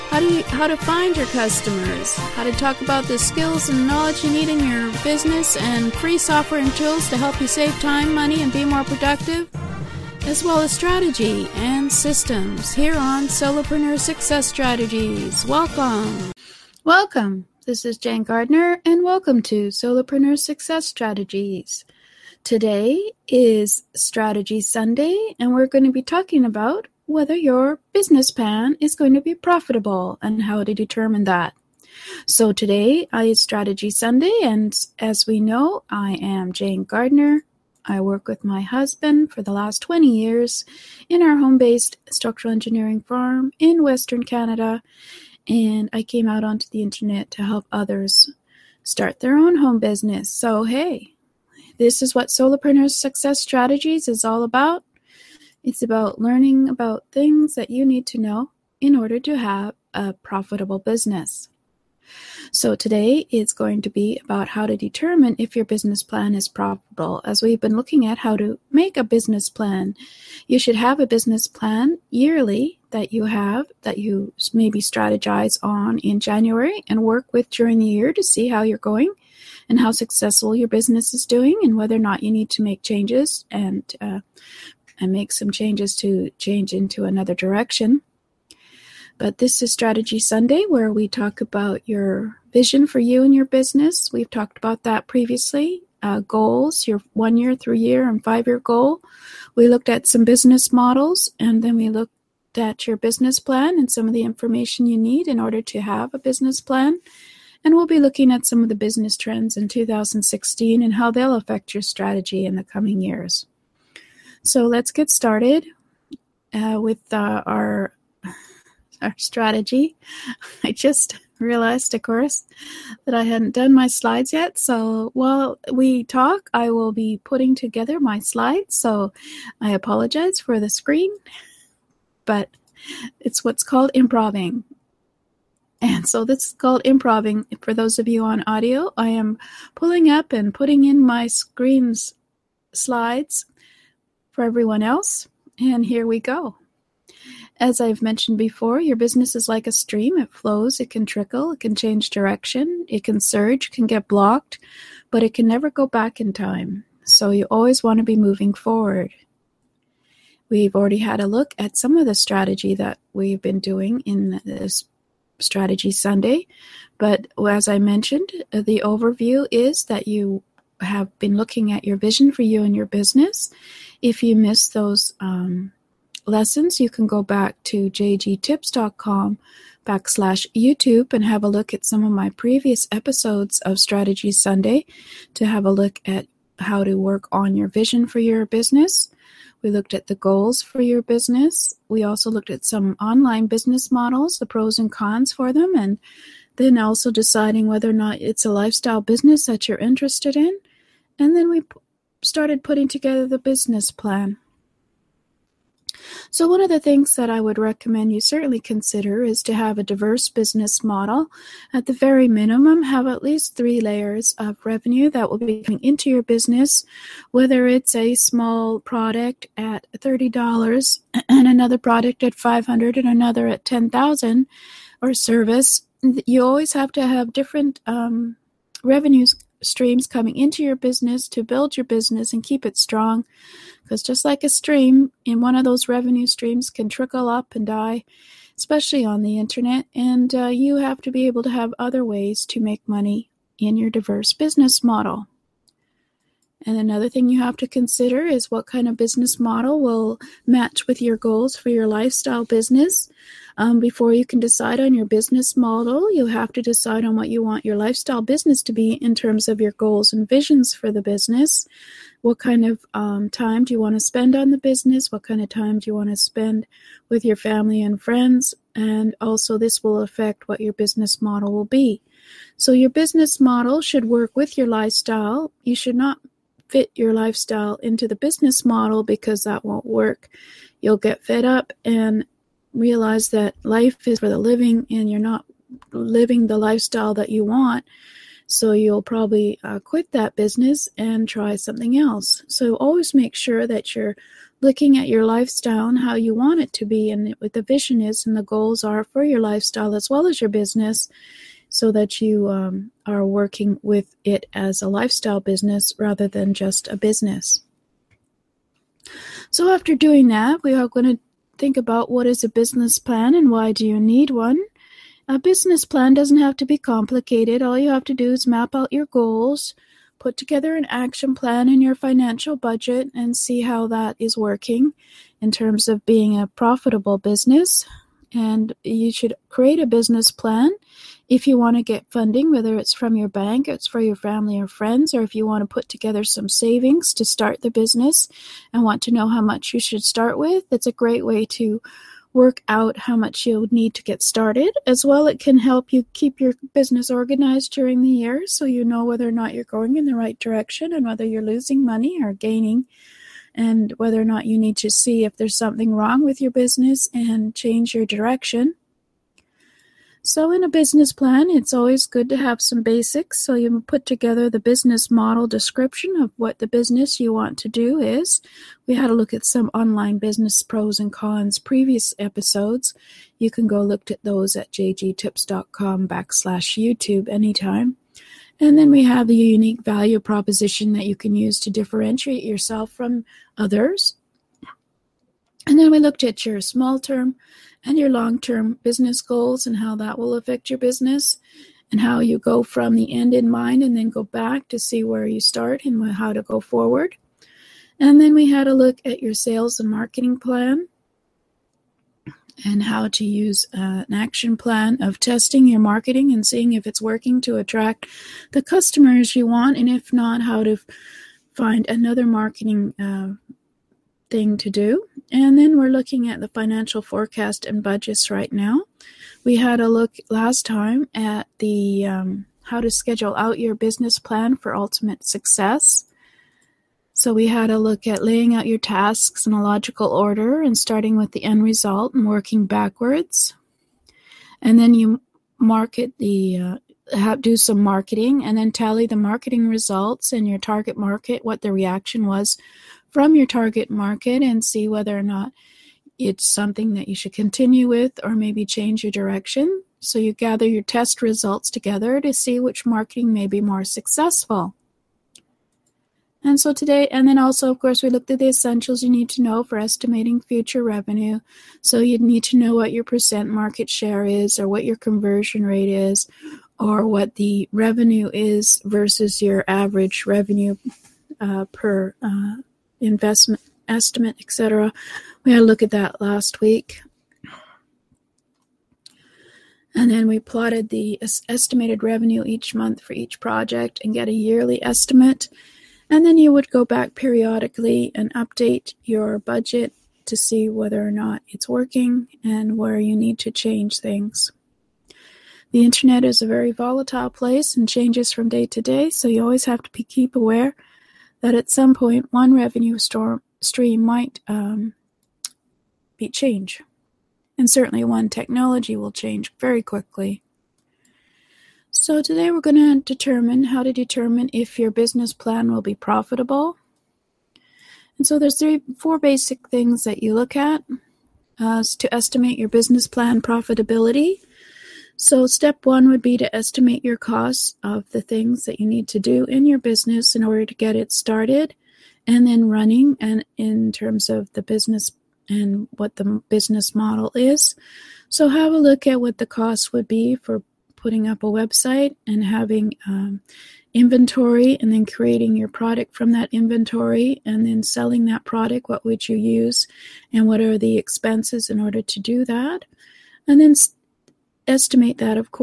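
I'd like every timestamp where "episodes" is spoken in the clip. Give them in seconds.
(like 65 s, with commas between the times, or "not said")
182 s, 372 s.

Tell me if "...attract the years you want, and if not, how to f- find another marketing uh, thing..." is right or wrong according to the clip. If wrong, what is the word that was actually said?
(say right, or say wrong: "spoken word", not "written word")
wrong: "customers", not "years".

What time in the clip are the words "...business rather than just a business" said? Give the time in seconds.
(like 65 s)
305 s.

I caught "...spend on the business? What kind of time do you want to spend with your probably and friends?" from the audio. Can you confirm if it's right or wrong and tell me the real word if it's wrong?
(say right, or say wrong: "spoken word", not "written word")
wrong: "family", not "probably".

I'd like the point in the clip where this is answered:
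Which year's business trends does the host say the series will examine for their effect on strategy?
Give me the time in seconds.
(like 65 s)
109 s.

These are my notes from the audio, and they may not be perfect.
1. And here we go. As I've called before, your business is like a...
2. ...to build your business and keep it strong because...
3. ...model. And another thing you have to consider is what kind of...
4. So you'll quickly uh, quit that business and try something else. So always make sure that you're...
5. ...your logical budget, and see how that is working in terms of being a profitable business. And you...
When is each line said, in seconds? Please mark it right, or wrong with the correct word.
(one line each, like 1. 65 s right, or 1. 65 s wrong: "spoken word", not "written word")
1. 145 s wrong: "mentioned", not "called"
2. 231 s right
3. 244 s right
4. 288 s wrong: "probably", not "quickly"
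5. 321 s wrong: "financial", not "logical".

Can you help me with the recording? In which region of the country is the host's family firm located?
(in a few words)
Western Canada.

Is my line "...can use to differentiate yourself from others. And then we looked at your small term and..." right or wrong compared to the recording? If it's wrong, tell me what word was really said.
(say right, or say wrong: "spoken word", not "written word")
right.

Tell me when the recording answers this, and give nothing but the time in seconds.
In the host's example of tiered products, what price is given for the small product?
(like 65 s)
219 s.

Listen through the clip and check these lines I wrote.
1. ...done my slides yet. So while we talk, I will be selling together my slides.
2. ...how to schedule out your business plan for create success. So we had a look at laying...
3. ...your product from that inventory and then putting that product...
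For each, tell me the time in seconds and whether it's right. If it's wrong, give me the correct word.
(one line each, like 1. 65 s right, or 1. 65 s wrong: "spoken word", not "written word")
1. 123 s wrong: "putting", not "selling"
2. 422 s wrong: "ultimate", not "create"
3. 545 s wrong: "selling", not "putting".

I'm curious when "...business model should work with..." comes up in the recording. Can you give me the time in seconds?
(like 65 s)
272 s.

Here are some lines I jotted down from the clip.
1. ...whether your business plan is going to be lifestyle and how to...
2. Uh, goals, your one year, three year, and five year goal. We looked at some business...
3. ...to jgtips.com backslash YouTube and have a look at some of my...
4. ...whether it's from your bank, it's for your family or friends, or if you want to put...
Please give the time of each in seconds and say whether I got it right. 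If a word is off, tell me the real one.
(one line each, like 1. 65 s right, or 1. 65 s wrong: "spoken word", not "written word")
1. 27 s wrong: "profitable", not "lifestyle"
2. 96 s right
3. 177 s right
4. 332 s right.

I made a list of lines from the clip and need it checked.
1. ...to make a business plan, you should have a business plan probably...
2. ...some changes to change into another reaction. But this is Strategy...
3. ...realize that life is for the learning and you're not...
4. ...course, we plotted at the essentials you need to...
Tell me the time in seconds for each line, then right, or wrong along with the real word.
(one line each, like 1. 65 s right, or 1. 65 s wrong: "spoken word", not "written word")
1. 68 s wrong: "yearly", not "probably"
2. 85 s wrong: "direction", not "reaction"
3. 282 s wrong: "living", not "learning"
4. 457 s wrong: "looked", not "plotted".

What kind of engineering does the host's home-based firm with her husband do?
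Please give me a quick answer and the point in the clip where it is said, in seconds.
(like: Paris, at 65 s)
Structural engineering, at 42 s.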